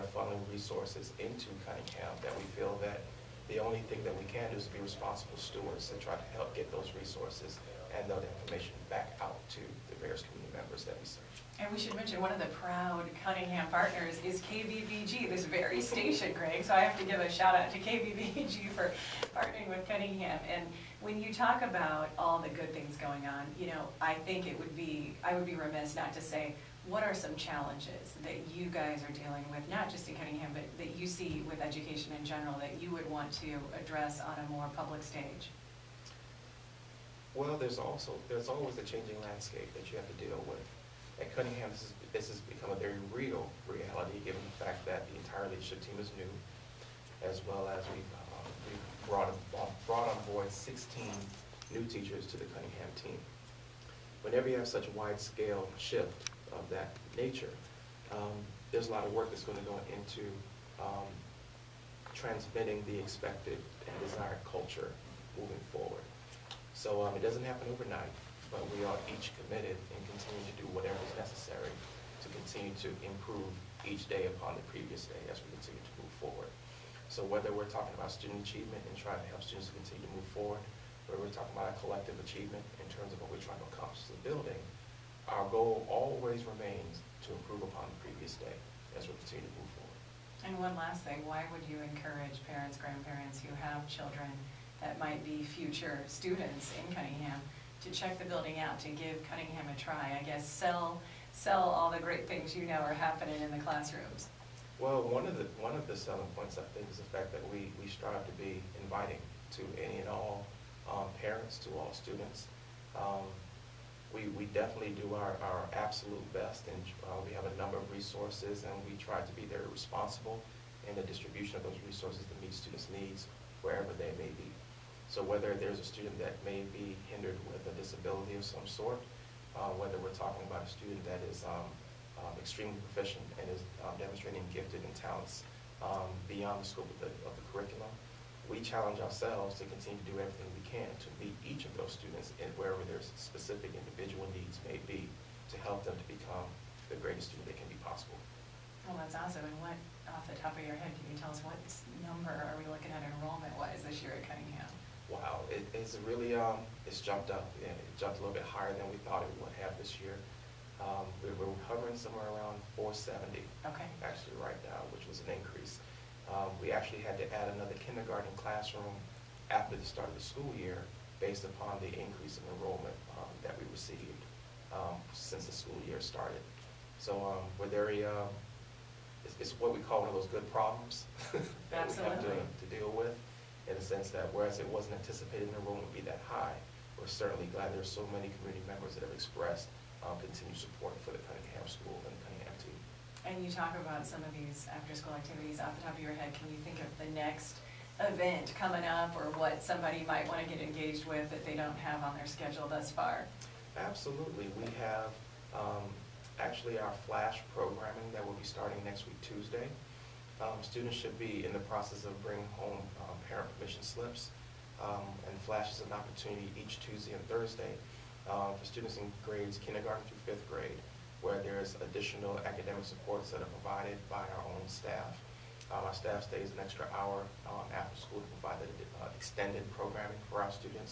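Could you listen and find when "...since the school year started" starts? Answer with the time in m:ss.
2:55.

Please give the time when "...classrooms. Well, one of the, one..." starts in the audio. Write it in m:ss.
1:43.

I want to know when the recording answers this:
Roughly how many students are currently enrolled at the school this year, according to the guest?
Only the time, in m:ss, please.
2:42.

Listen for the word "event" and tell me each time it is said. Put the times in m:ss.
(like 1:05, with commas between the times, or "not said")
3:17.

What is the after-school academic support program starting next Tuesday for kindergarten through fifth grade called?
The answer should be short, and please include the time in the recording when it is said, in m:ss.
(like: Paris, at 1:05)
flash, at 3:27.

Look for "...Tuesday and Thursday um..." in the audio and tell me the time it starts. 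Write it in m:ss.
3:36.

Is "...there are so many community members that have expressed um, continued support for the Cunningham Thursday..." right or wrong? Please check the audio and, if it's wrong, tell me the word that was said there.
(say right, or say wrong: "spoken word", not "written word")
wrong: "School", not "Thursday".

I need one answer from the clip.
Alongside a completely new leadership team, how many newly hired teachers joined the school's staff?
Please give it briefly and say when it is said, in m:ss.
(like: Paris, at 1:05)
16, at 0:50.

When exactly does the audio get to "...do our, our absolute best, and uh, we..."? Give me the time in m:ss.
1:55.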